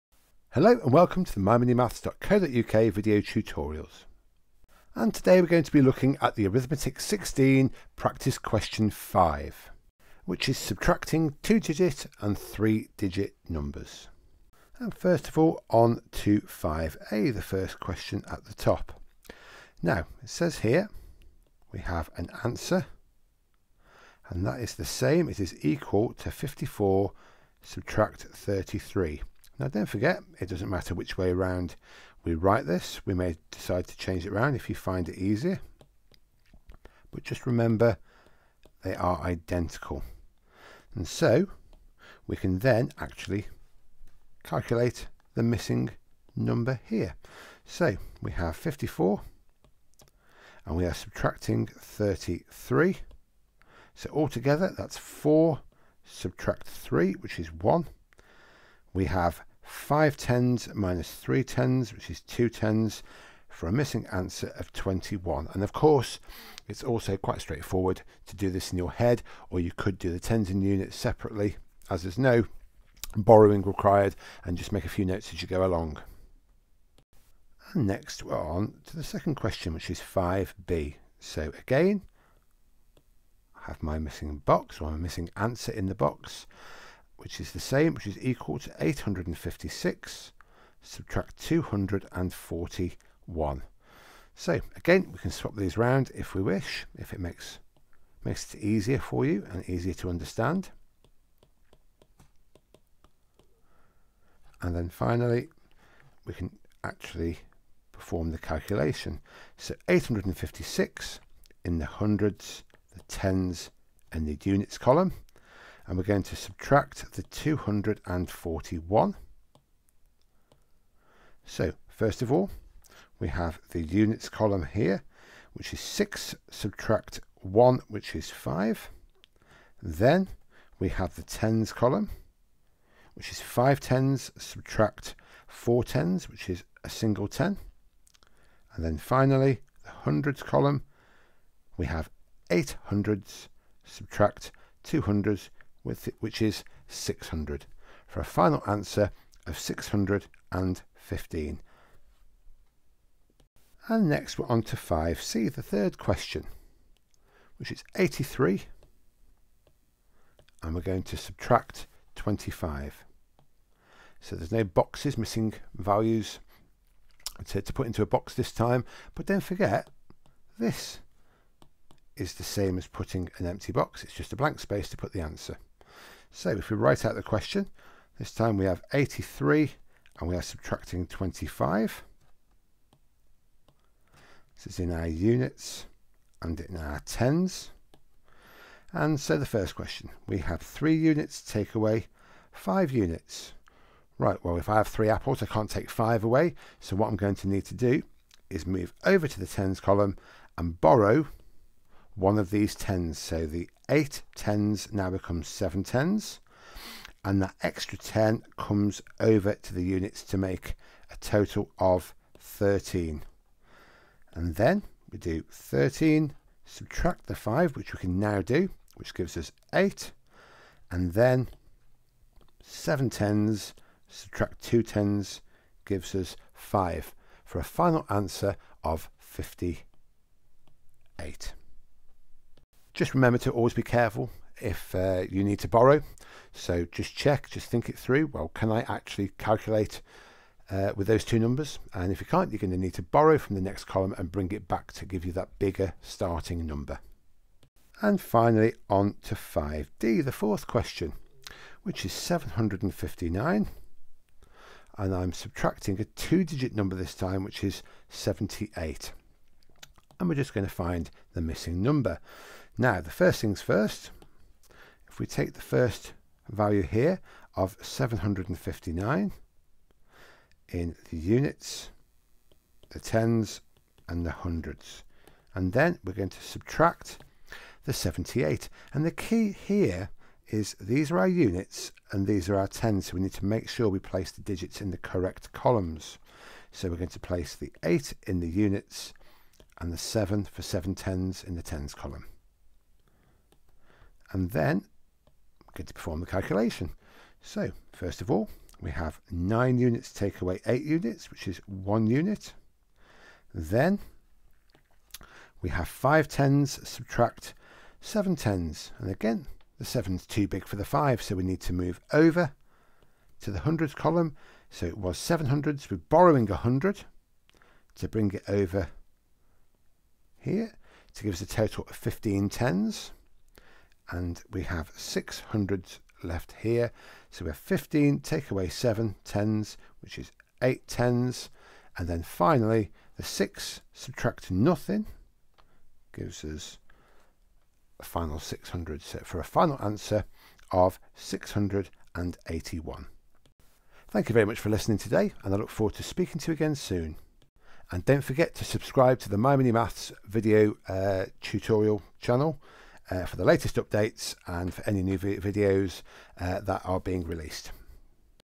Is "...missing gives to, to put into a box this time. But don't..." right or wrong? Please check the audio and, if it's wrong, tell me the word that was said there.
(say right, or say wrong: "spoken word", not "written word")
wrong: "values", not "gives".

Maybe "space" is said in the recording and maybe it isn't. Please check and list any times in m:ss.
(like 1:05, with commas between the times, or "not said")
2:54.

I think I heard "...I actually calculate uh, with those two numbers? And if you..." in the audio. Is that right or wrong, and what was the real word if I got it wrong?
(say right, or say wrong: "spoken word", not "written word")
right.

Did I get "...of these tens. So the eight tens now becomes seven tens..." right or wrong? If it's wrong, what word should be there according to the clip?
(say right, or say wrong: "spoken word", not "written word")
right.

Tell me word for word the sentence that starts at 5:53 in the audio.
Uh, for the latest updates and for any new videos uh, that are being released.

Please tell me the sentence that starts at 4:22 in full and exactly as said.
Now, the first things first, if we take the first value here of 759 in the units, the tens and the hundreds.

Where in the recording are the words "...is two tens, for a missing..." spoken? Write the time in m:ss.
1:02.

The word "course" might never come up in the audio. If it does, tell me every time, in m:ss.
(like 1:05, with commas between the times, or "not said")
1:05.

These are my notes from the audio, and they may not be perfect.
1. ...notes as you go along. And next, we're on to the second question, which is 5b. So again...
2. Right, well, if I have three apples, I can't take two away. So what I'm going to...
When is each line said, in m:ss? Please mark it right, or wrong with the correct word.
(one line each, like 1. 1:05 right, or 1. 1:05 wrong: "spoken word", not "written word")
1. 1:15 right
2. 3:14 wrong: "five", not "two".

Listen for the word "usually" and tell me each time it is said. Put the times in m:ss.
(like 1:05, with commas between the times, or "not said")
not said.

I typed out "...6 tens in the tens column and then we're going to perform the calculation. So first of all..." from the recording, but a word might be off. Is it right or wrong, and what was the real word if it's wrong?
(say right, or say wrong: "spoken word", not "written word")
wrong: "7", not "6".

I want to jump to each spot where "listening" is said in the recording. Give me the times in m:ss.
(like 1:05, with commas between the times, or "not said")
5:44.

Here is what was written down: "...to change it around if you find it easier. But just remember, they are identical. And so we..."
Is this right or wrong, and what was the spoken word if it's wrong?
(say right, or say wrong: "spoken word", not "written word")
right.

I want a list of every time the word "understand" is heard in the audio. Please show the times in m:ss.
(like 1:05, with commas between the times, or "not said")
1:40.